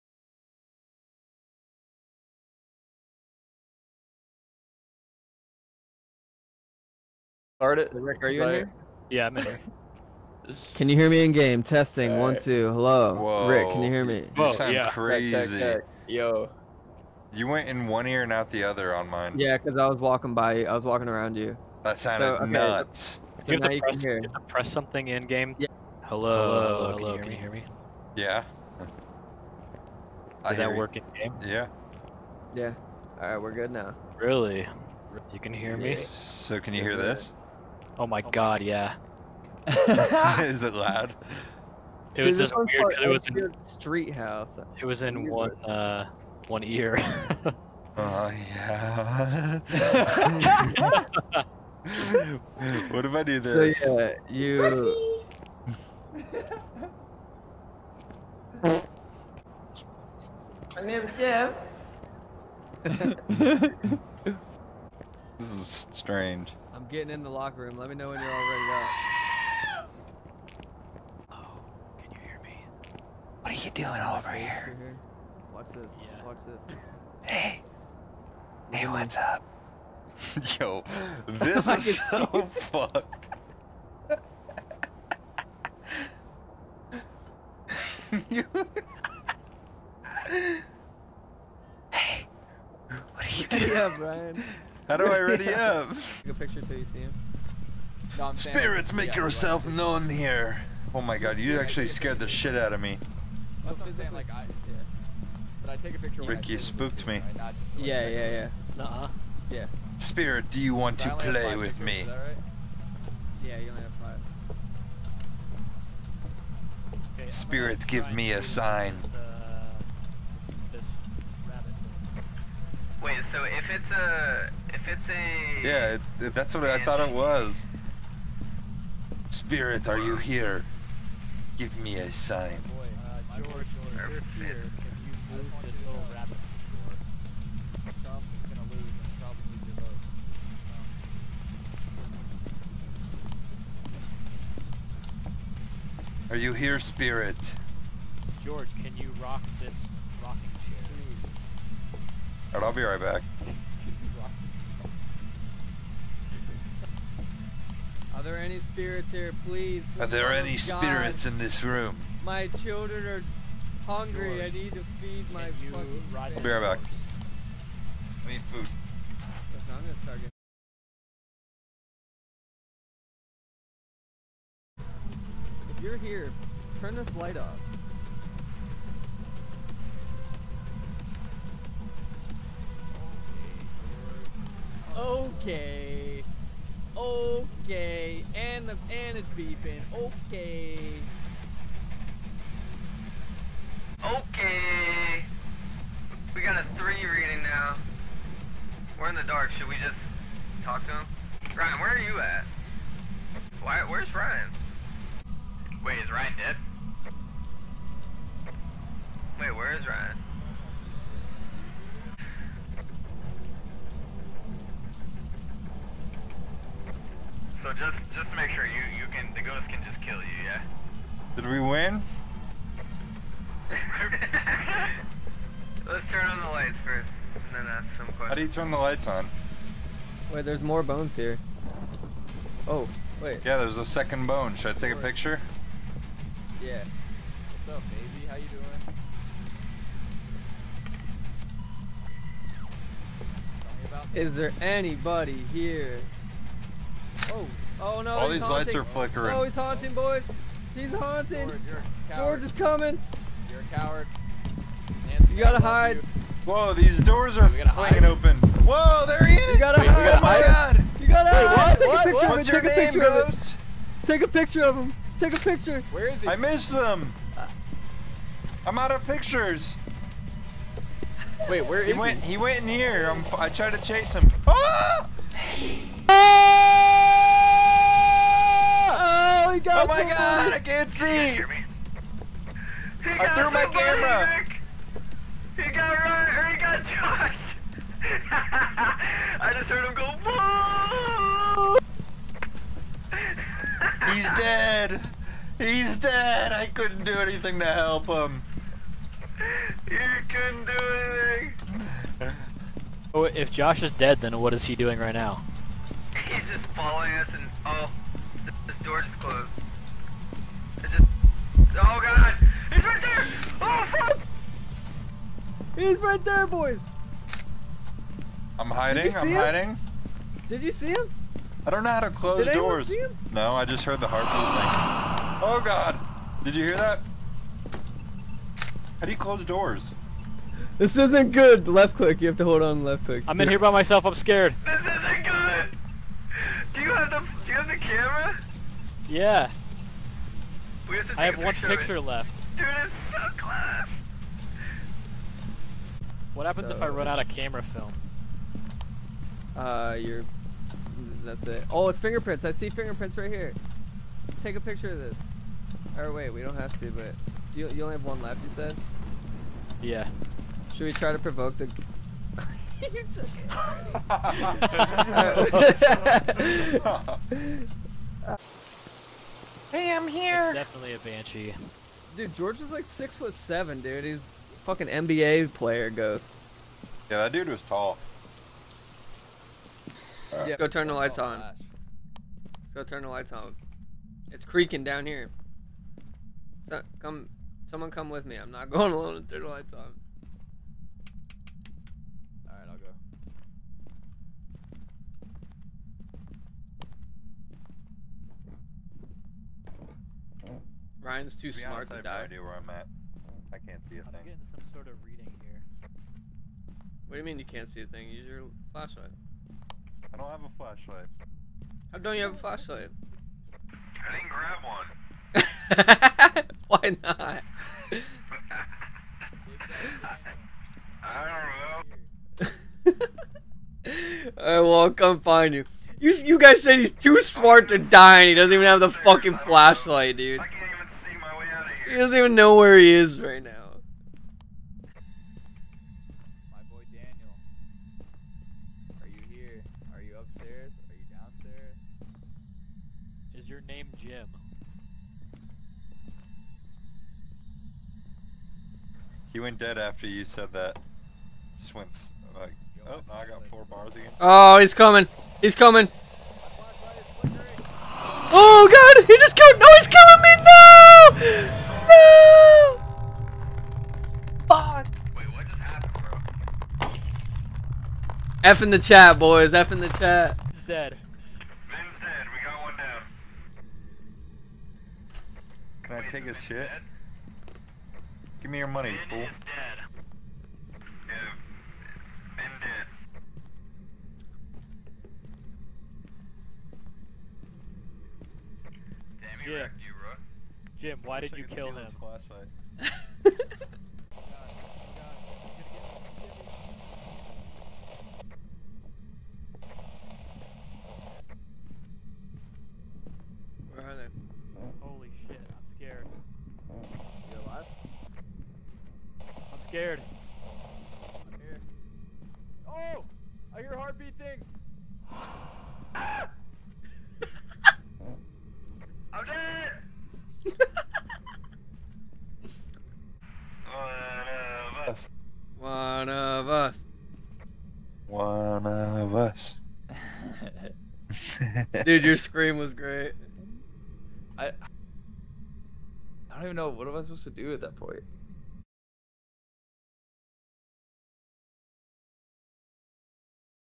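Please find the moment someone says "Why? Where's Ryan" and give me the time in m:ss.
3:23.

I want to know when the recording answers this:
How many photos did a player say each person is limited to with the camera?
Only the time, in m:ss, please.
1:53.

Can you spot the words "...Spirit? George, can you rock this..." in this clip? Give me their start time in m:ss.
2:26.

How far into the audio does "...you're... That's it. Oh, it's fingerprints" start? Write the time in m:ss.
5:49.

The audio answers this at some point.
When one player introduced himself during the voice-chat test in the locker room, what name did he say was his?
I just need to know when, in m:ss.
1:00.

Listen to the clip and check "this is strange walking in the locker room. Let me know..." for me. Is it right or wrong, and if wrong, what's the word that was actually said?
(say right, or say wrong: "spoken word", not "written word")
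wrong: "getting", not "walking".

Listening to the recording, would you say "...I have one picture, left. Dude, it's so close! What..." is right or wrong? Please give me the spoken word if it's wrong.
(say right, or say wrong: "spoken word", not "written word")
right.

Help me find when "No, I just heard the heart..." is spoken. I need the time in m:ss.
5:23.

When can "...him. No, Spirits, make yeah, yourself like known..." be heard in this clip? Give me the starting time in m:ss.
1:36.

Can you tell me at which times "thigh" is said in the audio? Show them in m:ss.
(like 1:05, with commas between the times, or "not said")
not said.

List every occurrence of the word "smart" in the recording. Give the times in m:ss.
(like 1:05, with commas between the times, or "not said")
6:41, 7:07.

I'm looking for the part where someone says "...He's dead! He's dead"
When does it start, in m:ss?
4:54.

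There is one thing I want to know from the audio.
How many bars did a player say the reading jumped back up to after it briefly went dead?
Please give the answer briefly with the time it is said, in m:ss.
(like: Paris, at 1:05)
4, at 7:33.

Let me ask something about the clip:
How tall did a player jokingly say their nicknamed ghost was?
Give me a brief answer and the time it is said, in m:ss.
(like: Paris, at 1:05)
six foot seven, at 6:12.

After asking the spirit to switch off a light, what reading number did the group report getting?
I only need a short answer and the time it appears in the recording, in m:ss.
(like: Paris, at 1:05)
3, at 3:16.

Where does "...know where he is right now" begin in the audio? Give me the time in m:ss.
7:12.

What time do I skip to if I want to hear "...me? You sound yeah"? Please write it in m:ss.
0:14.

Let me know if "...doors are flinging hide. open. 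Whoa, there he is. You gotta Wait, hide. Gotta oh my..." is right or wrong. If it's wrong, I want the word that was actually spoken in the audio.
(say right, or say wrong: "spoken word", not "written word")
right.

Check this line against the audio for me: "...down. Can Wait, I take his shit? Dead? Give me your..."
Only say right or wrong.
right.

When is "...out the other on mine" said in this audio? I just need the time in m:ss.
0:18.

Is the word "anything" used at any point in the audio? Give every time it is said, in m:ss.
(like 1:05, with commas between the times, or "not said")
4:57, 5:01.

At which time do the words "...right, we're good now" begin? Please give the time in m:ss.
0:33.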